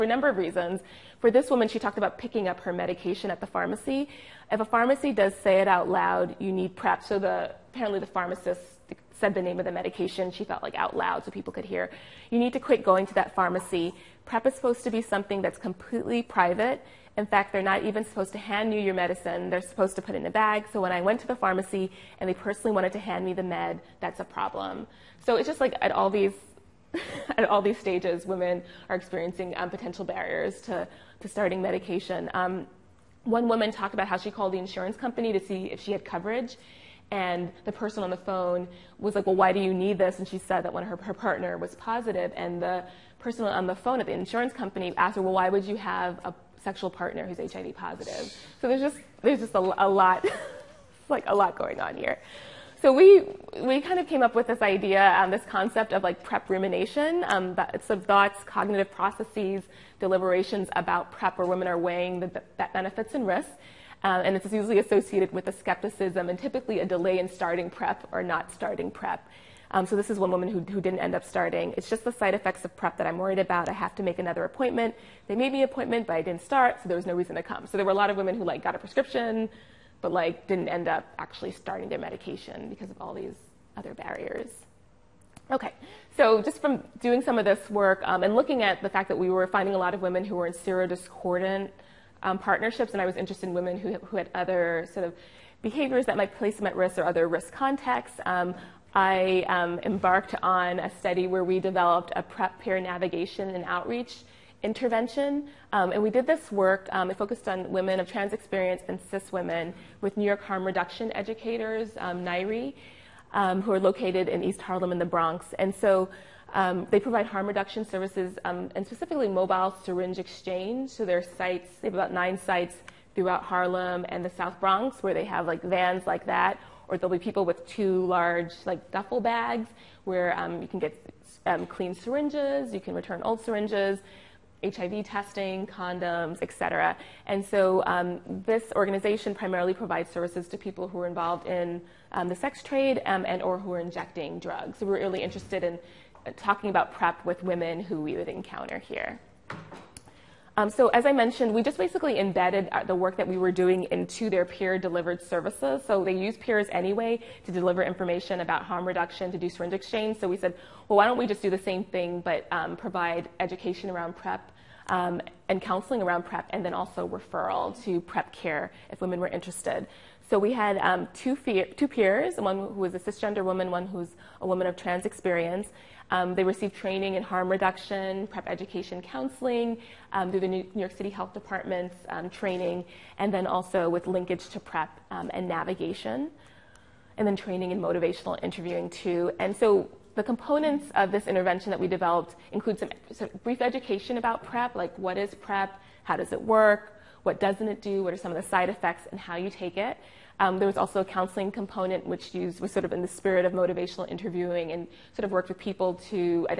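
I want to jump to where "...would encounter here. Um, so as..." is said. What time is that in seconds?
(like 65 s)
148 s.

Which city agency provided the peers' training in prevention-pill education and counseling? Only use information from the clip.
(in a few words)
New York City Health Department.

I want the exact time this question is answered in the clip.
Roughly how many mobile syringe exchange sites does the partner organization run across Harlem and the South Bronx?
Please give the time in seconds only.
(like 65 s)
122 s.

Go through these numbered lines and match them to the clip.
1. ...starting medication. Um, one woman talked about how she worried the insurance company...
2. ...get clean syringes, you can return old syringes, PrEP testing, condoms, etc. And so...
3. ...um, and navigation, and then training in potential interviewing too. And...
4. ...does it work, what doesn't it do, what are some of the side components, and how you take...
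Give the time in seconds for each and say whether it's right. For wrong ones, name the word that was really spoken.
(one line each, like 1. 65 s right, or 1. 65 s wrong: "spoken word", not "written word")
1. 31 s wrong: "called", not "worried"
2. 130 s wrong: "HIV", not "PrEP"
3. 185 s wrong: "motivational", not "potential"
4. 196 s wrong: "effects", not "components".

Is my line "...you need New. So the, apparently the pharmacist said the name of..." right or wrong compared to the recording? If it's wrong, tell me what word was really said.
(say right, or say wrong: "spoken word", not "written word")
wrong: "PrEP", not "New".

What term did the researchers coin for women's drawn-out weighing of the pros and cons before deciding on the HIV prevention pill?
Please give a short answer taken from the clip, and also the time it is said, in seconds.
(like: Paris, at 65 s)
PrEP rumination, at 56 s.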